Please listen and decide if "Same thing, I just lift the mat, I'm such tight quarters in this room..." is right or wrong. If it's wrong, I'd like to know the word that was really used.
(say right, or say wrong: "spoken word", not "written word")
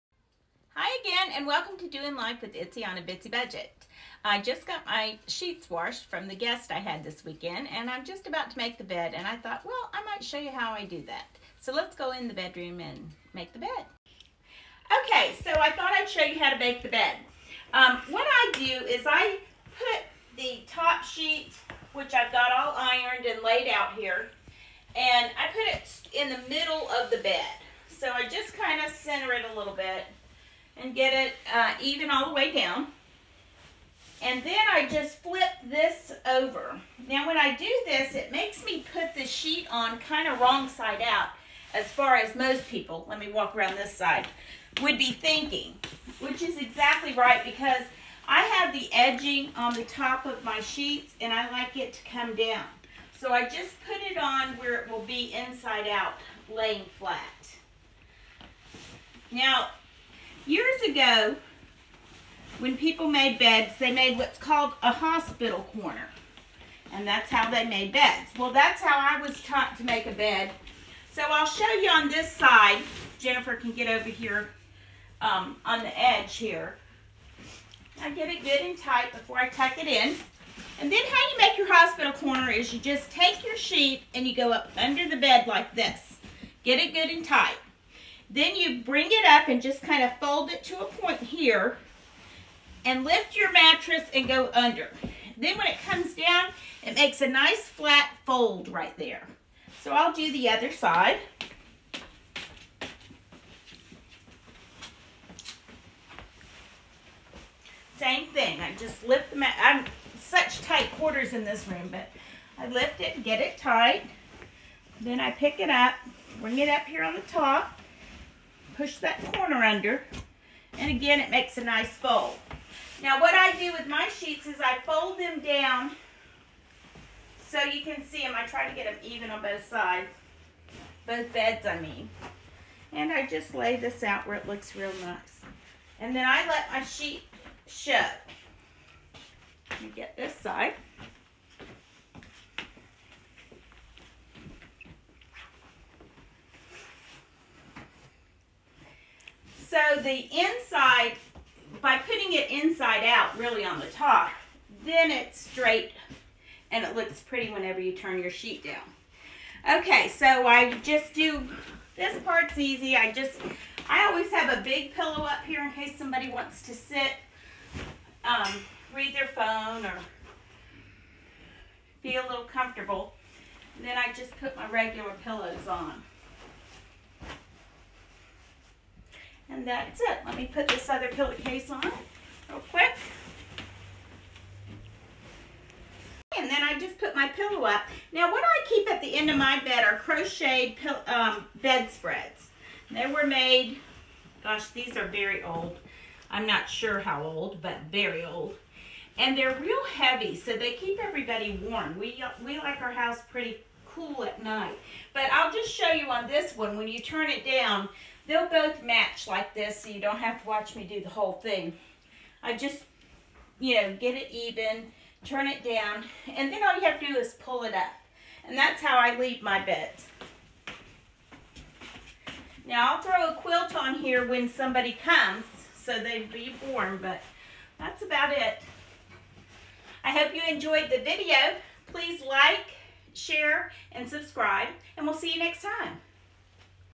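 right.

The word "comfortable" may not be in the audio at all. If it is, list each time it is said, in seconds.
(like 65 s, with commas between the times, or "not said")
172 s.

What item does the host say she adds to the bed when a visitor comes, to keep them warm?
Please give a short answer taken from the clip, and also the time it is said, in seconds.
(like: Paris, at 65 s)
a quilt, at 223 s.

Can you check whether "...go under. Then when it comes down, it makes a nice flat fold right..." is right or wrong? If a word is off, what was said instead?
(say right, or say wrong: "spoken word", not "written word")
right.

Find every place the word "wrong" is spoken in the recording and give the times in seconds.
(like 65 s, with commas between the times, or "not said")
40 s.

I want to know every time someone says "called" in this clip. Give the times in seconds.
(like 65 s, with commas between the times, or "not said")
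64 s.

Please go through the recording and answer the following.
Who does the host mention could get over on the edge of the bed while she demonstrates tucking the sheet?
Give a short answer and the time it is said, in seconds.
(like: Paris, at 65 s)
Jennifer, at 73 s.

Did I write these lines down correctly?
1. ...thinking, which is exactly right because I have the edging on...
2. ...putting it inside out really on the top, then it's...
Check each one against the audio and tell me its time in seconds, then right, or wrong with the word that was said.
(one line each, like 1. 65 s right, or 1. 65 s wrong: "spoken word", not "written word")
1. 45 s right
2. 151 s right.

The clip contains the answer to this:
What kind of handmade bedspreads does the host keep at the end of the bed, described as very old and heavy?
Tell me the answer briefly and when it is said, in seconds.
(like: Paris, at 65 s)
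crocheted, at 189 s.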